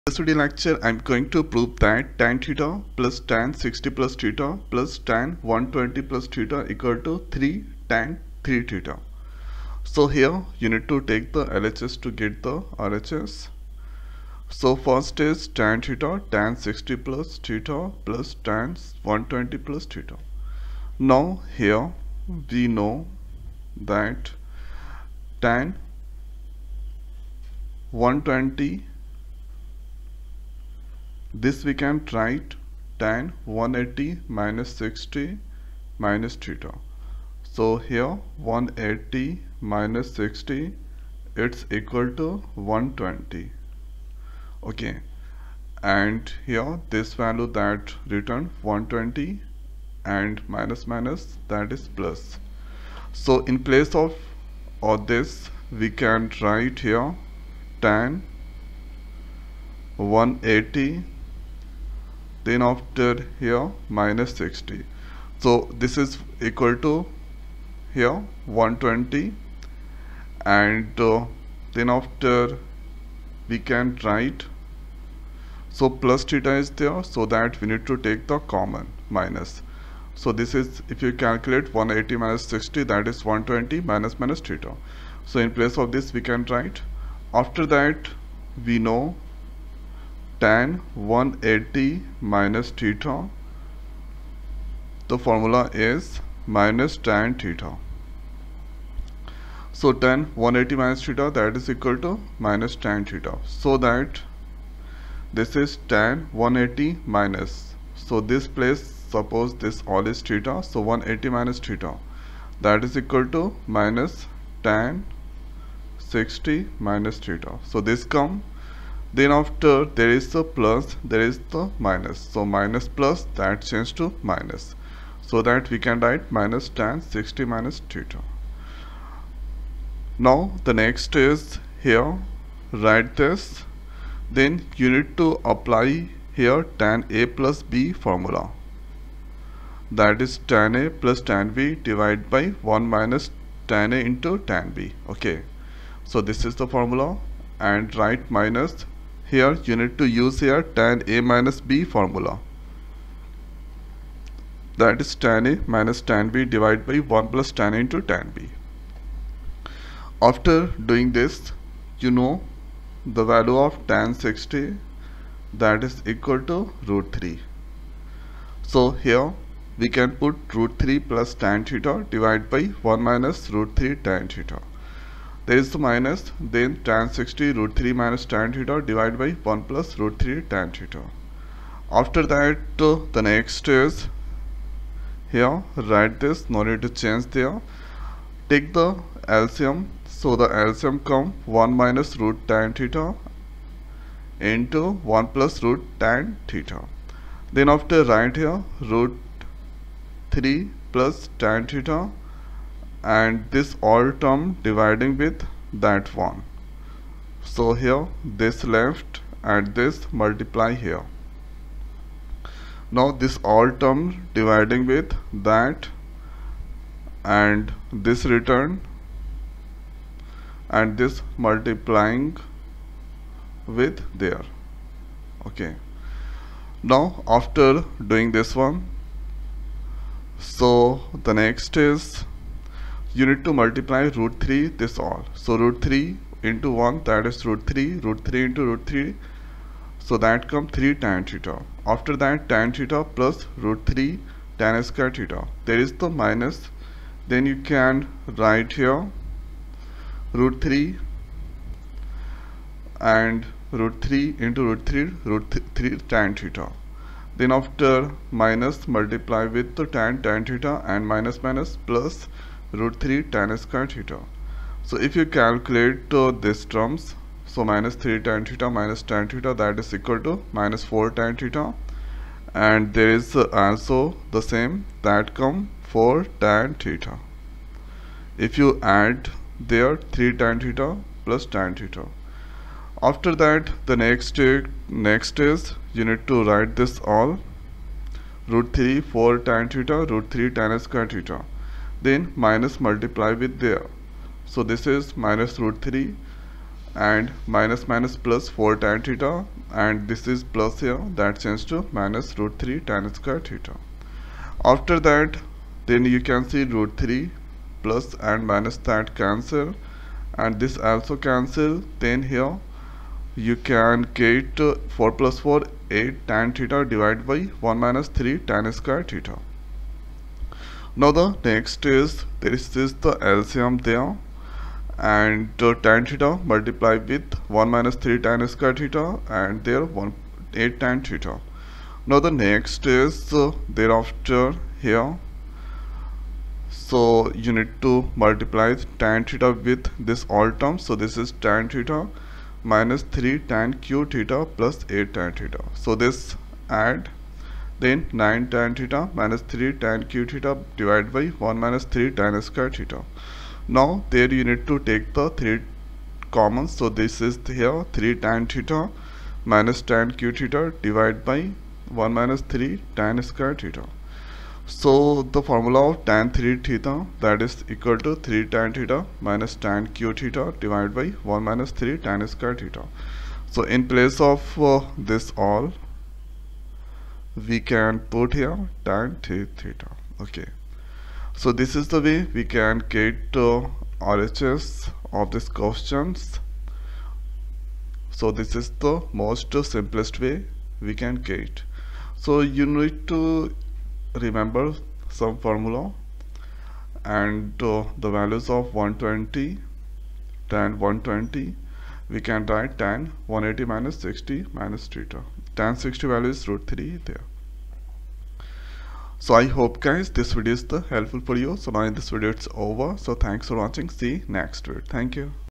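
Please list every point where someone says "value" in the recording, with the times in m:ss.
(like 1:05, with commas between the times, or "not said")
0:47, 2:43, 6:38, 6:46.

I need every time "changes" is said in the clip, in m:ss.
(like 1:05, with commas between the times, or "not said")
2:03, 3:07, 5:01.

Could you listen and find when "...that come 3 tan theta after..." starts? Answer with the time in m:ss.
4:00.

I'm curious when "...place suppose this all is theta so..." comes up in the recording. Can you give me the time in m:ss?
1:48.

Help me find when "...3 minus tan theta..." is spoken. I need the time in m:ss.
2:57.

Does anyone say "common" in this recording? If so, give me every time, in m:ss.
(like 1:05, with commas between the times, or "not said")
1:18, 5:56.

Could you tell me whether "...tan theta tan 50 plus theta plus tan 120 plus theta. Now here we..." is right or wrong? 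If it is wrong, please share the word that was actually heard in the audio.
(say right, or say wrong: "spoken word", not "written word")
wrong: "60", not "50".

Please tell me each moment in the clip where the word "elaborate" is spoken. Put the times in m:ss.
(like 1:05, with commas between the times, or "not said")
not said.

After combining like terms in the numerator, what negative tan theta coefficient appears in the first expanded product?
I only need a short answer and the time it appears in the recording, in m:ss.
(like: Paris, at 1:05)
-4, at 4:30.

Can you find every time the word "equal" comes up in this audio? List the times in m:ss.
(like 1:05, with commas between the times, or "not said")
0:06, 0:41, 1:06, 1:41, 1:53, 2:46, 4:29, 6:07.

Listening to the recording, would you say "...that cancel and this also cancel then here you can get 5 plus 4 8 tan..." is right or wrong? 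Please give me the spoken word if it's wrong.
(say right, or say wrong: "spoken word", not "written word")
wrong: "4", not "5".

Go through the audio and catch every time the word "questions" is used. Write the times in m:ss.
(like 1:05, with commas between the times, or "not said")
6:25.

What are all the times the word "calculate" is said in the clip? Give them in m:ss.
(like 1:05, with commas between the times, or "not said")
1:21, 4:25.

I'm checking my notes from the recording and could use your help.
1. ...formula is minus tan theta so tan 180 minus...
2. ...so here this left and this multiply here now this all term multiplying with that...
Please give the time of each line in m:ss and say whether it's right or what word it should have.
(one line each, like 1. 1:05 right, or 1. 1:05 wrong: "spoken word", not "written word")
1. 1:35 right
2. 3:27 wrong: "dividing", not "multiplying".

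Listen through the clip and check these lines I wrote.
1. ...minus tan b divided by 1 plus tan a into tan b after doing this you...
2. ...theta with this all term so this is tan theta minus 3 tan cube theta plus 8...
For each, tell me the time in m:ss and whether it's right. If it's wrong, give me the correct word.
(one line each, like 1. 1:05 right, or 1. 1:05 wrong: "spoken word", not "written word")
1. 2:35 right
2. 5:39 right.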